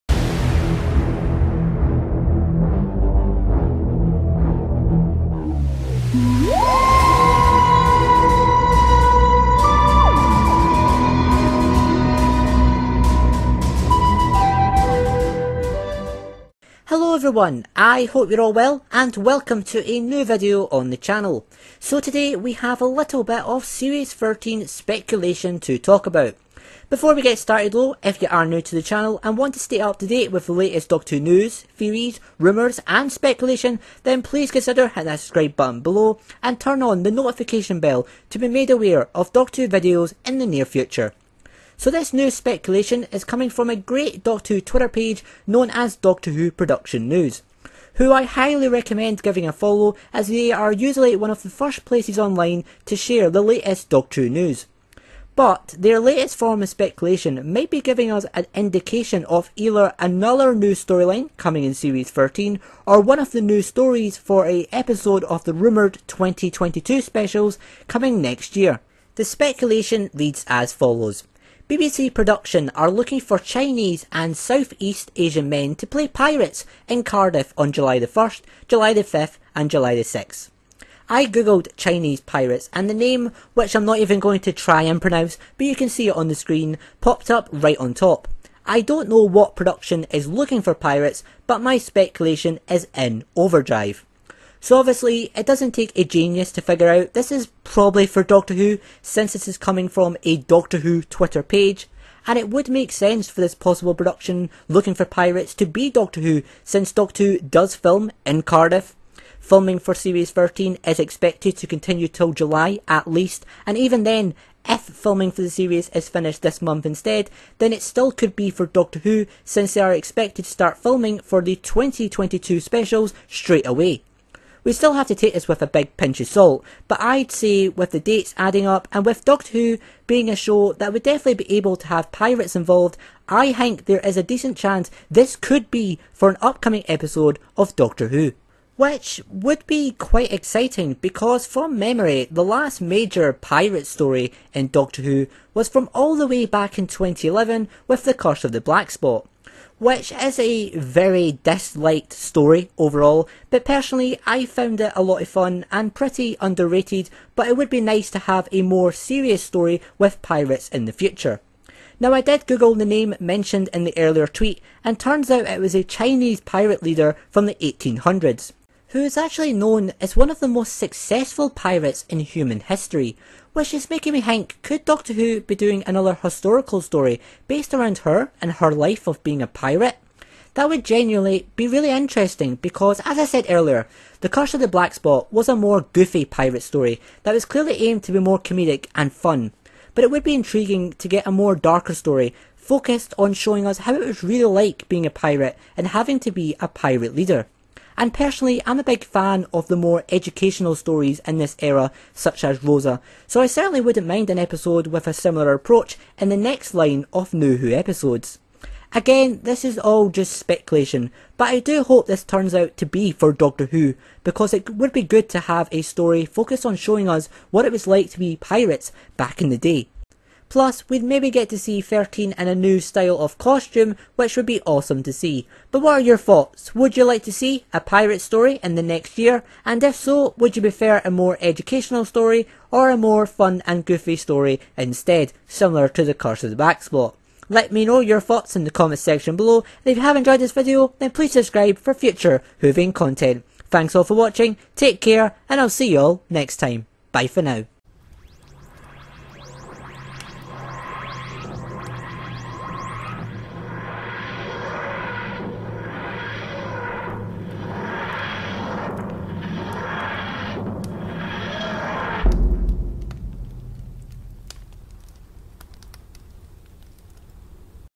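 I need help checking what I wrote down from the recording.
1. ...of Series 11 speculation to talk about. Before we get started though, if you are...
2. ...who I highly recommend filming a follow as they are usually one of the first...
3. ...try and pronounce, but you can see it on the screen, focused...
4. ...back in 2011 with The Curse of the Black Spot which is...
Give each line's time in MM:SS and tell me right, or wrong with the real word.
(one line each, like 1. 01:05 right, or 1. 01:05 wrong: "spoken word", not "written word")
1. 00:23 wrong: "13", not "11"
2. 00:47 wrong: "giving", not "filming"
3. 01:24 wrong: "popped", not "focused"
4. 02:26 right.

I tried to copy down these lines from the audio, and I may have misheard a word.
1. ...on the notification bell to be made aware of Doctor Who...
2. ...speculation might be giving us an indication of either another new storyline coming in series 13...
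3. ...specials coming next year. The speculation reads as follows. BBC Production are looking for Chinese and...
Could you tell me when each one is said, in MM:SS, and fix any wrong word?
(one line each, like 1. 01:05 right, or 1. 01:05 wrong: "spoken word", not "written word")
1. 00:36 right
2. 00:56 right
3. 01:07 right.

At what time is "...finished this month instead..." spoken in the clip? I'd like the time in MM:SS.
01:56.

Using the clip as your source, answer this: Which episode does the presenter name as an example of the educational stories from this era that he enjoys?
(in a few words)
Rosa.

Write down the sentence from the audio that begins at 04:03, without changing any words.
Thanks all for watching, take care, and I'll see you all next time.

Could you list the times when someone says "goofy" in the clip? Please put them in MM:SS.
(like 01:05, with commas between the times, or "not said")
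03:05, 03:53.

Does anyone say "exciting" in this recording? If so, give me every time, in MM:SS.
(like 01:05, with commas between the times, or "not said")
02:20.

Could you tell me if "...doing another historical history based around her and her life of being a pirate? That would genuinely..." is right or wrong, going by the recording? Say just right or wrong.
wrong.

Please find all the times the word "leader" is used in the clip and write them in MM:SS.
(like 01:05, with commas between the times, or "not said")
02:46, 03:17.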